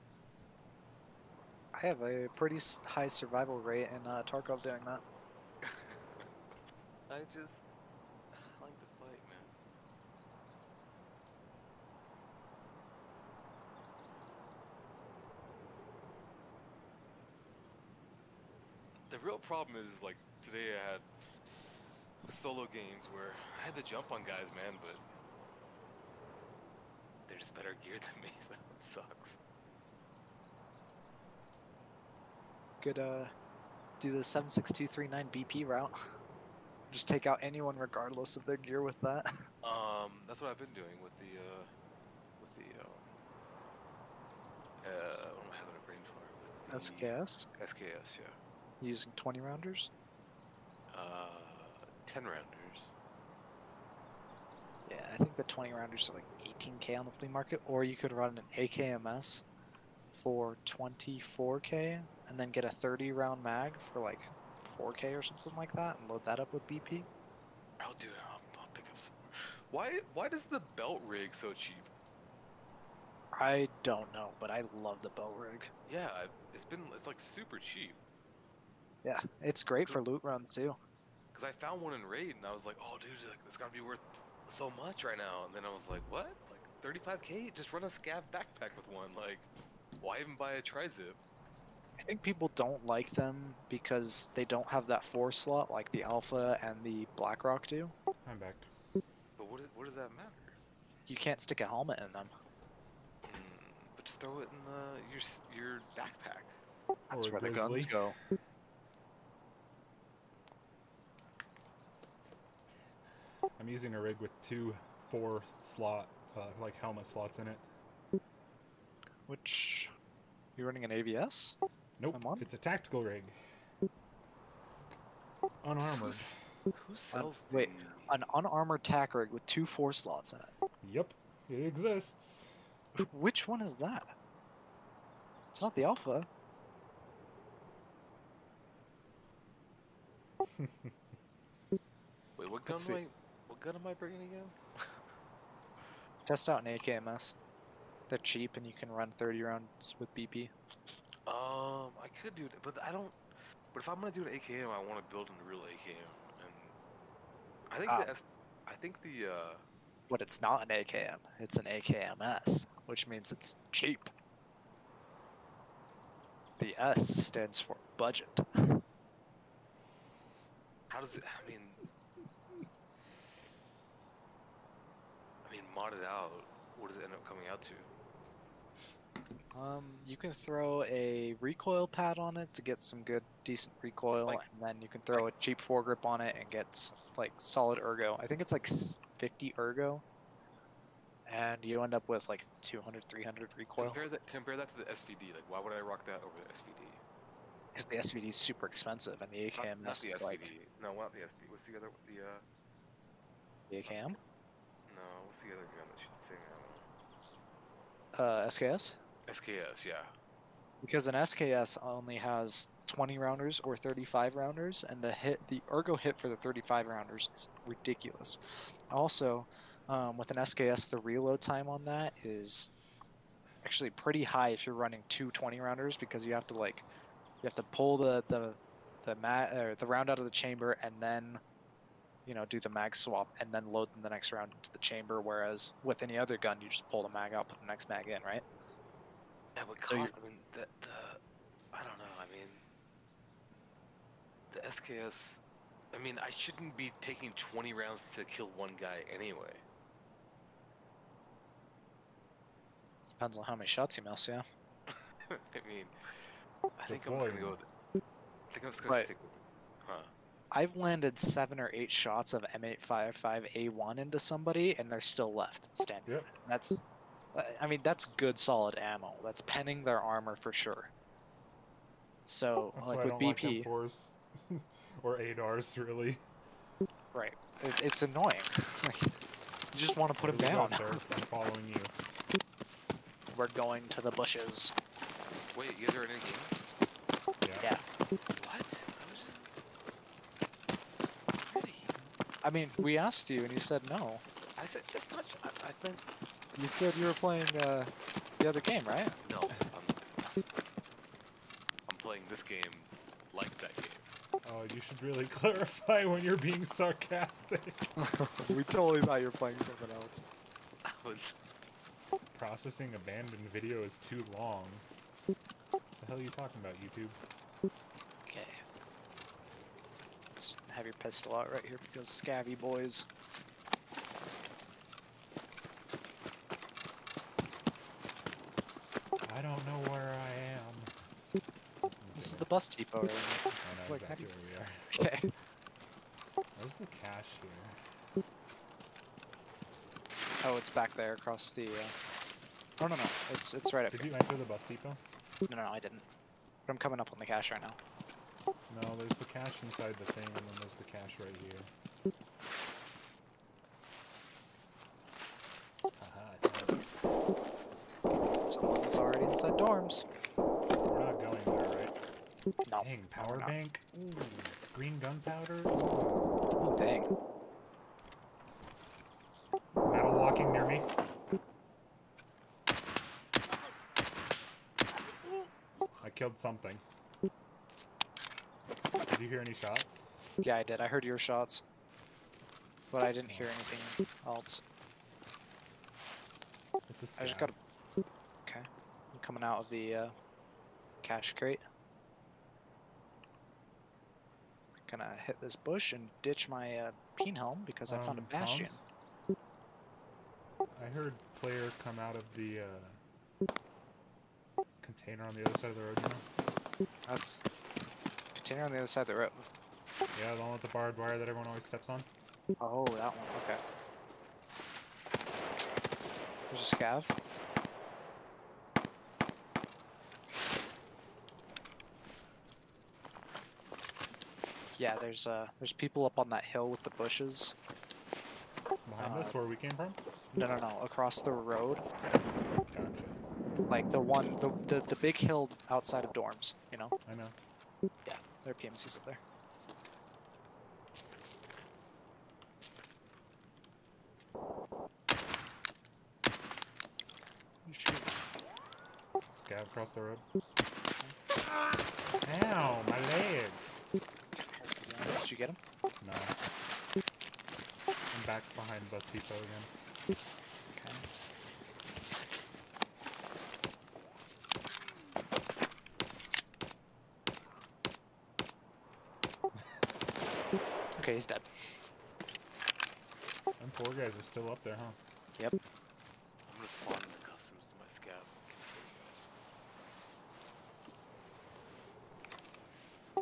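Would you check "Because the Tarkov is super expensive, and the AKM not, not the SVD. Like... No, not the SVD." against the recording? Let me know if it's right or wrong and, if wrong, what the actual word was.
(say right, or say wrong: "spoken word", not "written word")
wrong: "SVD", not "Tarkov".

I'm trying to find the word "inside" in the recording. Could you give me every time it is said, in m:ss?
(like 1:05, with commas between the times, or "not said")
5:49, 5:59.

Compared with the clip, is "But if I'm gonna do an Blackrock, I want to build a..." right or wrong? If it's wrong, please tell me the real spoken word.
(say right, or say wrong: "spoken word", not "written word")
wrong: "AKM", not "Blackrock".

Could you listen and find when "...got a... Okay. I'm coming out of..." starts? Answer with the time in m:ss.
6:27.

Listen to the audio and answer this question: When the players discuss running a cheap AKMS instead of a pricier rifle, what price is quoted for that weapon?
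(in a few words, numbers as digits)
24k.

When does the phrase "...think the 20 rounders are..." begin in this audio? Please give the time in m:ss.
0:55.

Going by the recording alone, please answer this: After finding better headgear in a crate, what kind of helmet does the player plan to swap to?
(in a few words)
bastion.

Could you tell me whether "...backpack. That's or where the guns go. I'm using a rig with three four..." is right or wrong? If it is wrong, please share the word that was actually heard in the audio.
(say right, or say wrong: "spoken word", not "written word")
wrong: "two", not "three".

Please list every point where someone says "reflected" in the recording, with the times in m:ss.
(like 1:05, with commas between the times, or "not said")
not said.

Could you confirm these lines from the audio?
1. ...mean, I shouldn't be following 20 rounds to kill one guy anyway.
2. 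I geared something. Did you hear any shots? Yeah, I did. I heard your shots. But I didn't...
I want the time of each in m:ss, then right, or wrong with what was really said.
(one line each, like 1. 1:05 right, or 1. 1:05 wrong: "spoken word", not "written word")
1. 4:06 wrong: "taking", not "following"
2. 6:16 wrong: "killed", not "geared".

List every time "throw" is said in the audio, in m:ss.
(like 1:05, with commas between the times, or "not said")
1:44, 3:00, 3:05.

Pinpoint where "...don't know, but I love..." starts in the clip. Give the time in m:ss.
1:13.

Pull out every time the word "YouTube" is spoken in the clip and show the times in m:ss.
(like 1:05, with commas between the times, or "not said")
5:16.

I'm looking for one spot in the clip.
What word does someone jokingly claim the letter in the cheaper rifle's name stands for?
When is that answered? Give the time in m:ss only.
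2:47.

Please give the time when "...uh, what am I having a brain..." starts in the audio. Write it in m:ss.
0:44.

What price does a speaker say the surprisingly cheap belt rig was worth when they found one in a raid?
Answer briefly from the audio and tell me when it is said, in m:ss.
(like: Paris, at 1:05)
35k, at 1:26.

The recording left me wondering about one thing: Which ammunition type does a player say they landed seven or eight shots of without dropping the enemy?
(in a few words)
M855A1.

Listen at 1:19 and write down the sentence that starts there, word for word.
Yeah, it's great for loot runs too.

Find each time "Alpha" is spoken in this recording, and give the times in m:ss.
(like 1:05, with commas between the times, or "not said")
1:36, 2:15.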